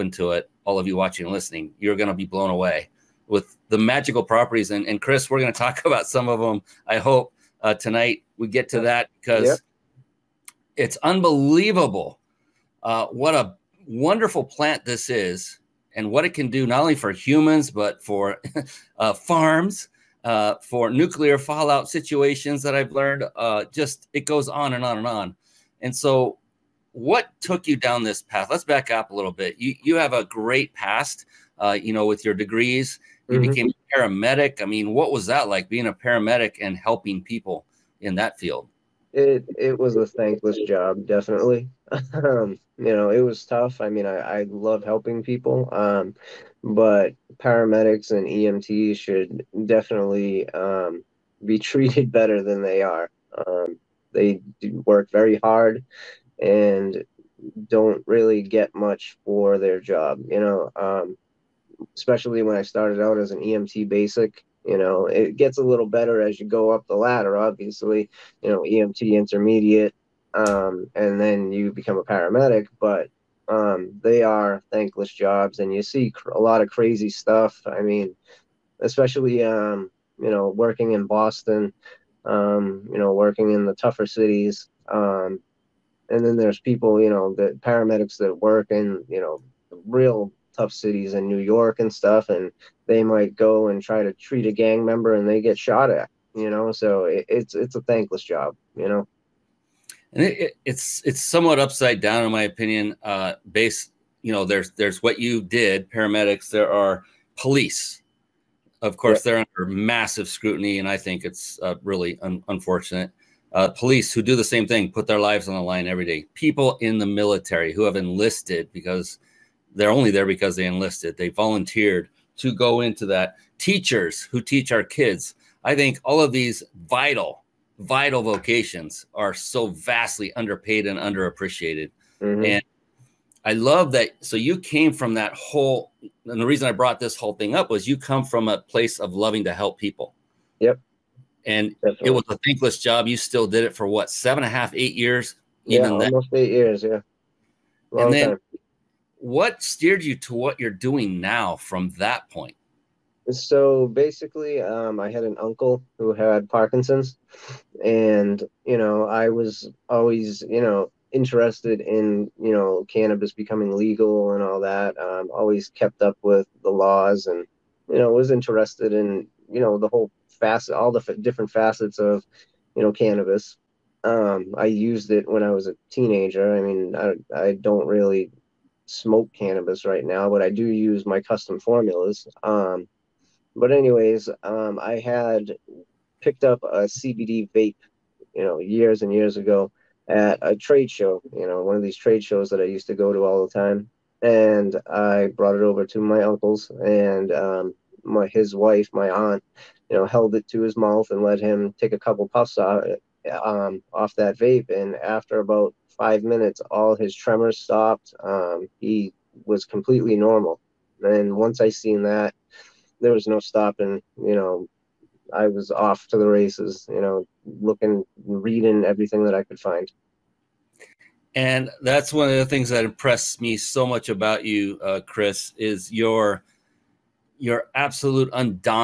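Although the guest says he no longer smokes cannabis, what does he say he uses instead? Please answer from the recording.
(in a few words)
custom formulas.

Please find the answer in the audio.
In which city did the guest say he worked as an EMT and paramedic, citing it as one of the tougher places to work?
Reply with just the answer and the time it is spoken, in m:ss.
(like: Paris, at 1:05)
Boston, at 1:21.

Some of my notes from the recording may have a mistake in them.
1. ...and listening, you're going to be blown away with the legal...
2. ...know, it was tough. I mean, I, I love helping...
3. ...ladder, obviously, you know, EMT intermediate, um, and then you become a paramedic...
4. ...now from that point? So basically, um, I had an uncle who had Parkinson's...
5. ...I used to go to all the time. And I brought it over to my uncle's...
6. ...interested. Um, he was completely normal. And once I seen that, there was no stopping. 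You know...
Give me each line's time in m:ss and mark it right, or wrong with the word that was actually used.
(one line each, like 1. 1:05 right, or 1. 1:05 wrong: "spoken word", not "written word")
1. 0:01 wrong: "magical", not "legal"
2. 0:42 right
3. 1:06 right
4. 2:31 right
5. 3:12 right
6. 3:27 wrong: "stopped", not "interested".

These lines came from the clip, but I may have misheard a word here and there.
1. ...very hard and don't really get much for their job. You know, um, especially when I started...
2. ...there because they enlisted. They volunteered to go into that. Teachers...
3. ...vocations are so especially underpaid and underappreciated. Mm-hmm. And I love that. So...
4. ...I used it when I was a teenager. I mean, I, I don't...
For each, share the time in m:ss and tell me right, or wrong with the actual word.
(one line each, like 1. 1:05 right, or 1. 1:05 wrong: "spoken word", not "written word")
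1. 0:55 right
2. 2:00 right
3. 2:08 wrong: "vastly", not "especially"
4. 2:54 right.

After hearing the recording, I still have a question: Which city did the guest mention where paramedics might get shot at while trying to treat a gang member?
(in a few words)
New York.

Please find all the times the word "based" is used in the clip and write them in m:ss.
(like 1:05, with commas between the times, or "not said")
1:43.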